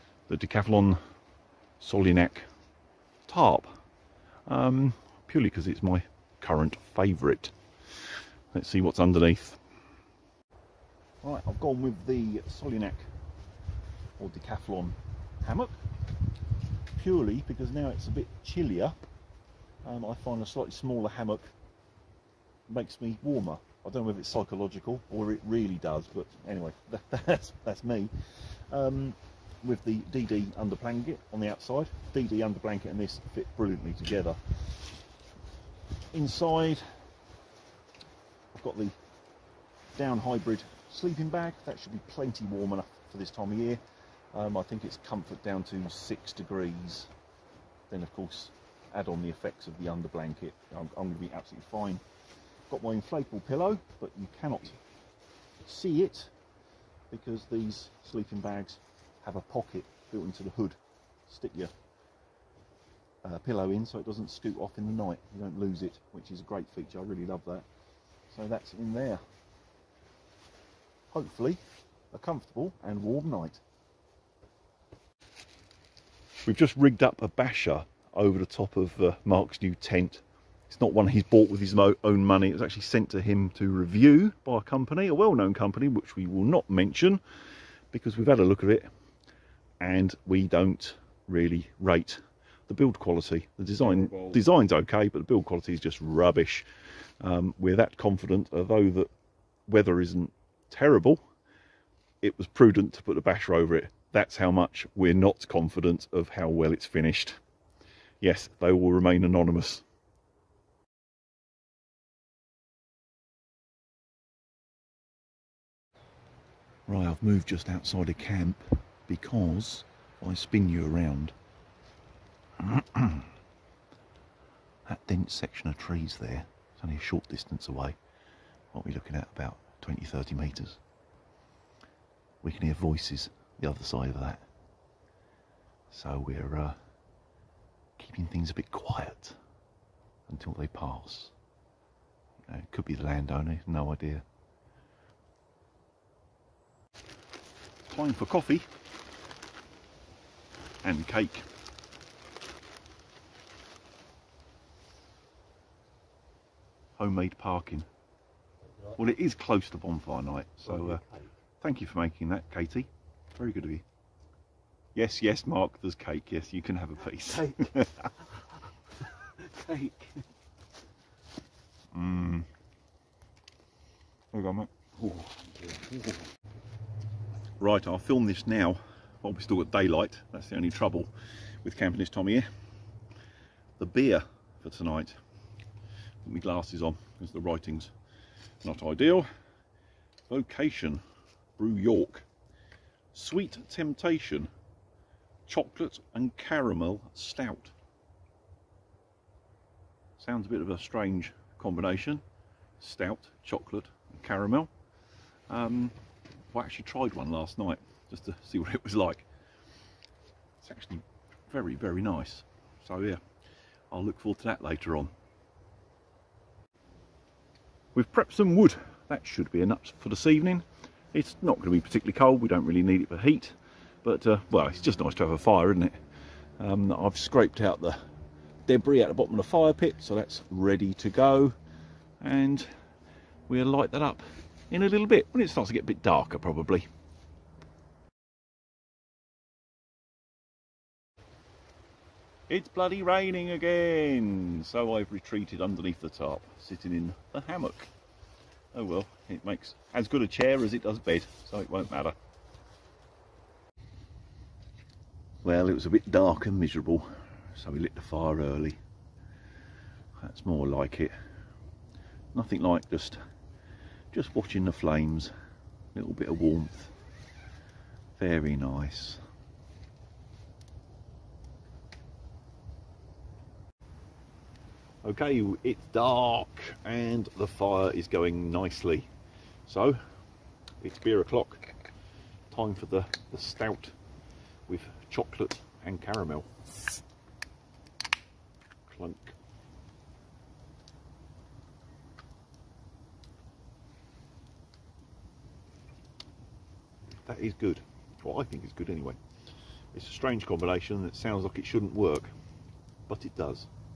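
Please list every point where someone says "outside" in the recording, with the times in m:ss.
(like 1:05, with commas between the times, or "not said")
0:31, 1:57.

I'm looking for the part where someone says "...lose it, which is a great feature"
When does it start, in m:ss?
1:05.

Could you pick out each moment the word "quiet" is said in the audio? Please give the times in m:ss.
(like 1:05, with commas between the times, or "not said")
2:18.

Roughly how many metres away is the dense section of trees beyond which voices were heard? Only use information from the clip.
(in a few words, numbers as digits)
20, 30 metres.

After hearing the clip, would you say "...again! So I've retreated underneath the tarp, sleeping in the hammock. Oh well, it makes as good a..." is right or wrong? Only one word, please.
wrong.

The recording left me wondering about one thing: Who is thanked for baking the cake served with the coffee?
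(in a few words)
Katie.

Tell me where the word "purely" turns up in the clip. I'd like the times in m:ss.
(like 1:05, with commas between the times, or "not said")
0:05, 0:17.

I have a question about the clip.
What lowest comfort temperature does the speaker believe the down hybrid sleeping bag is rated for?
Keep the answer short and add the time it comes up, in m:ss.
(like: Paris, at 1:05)
6 degrees, at 0:45.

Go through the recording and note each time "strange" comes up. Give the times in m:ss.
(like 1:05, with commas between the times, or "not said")
3:20, 5:00.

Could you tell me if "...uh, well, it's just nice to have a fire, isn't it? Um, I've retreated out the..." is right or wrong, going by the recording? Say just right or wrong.
wrong.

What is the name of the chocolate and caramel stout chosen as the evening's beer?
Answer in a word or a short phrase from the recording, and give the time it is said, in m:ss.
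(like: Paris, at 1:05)
Sweet Temptation, at 3:13.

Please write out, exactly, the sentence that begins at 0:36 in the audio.
Inside, I've got the down hybrid sleeping bag.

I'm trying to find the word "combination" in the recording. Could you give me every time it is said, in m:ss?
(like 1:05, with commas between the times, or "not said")
3:21, 5:00.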